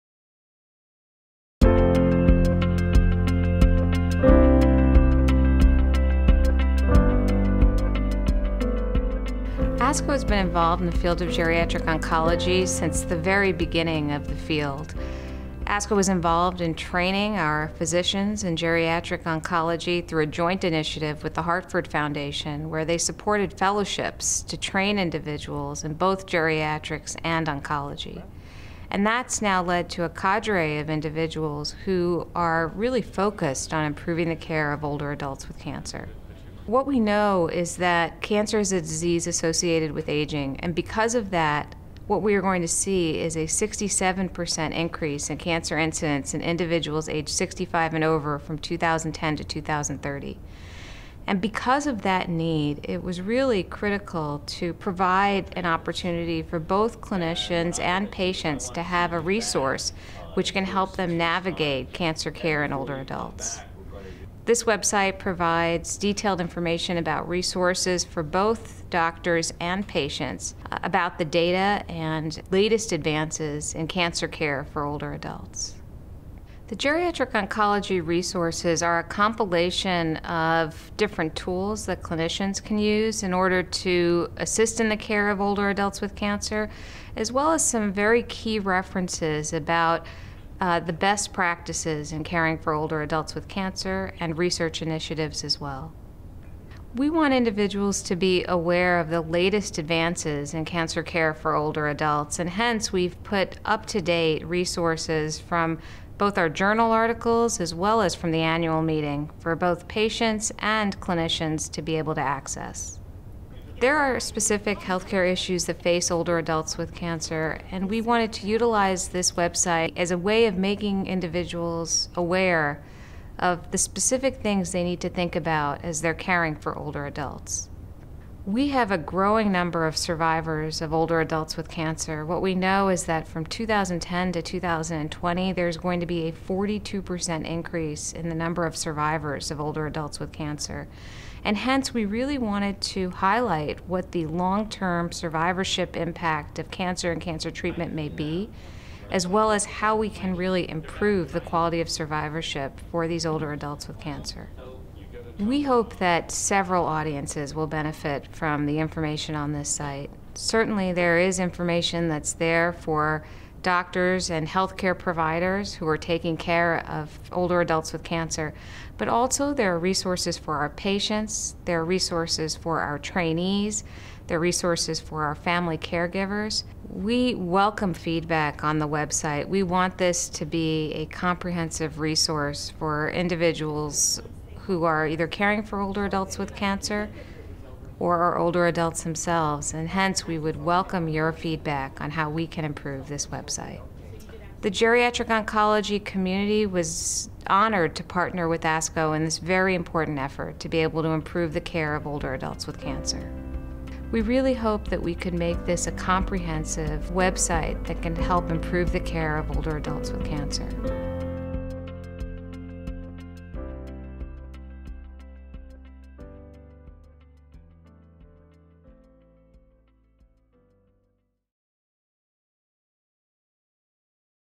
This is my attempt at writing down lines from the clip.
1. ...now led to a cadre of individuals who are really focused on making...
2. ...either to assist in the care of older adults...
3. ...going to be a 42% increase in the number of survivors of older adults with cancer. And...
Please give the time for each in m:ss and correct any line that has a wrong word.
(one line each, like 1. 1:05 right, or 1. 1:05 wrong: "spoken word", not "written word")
1. 0:29 wrong: "improving", not "making"
2. 1:23 wrong: "order", not "either"
3. 2:15 right.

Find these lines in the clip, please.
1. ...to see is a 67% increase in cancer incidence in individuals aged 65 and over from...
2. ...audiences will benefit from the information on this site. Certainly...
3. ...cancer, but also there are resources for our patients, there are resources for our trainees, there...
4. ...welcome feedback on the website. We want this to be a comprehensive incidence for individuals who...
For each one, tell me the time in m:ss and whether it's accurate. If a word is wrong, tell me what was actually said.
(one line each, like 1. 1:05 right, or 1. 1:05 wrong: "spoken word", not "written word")
1. 0:42 right
2. 2:36 right
3. 2:48 right
4. 2:57 wrong: "resource", not "incidence".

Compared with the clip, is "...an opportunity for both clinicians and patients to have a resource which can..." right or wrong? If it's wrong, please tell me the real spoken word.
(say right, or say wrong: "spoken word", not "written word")
right.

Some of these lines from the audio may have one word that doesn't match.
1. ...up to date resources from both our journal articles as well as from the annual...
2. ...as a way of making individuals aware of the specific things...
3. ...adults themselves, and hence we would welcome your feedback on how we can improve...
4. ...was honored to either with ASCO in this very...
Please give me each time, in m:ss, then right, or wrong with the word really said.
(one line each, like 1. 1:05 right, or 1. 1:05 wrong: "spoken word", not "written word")
1. 1:43 right
2. 1:59 right
3. 3:08 right
4. 3:16 wrong: "partner", not "either".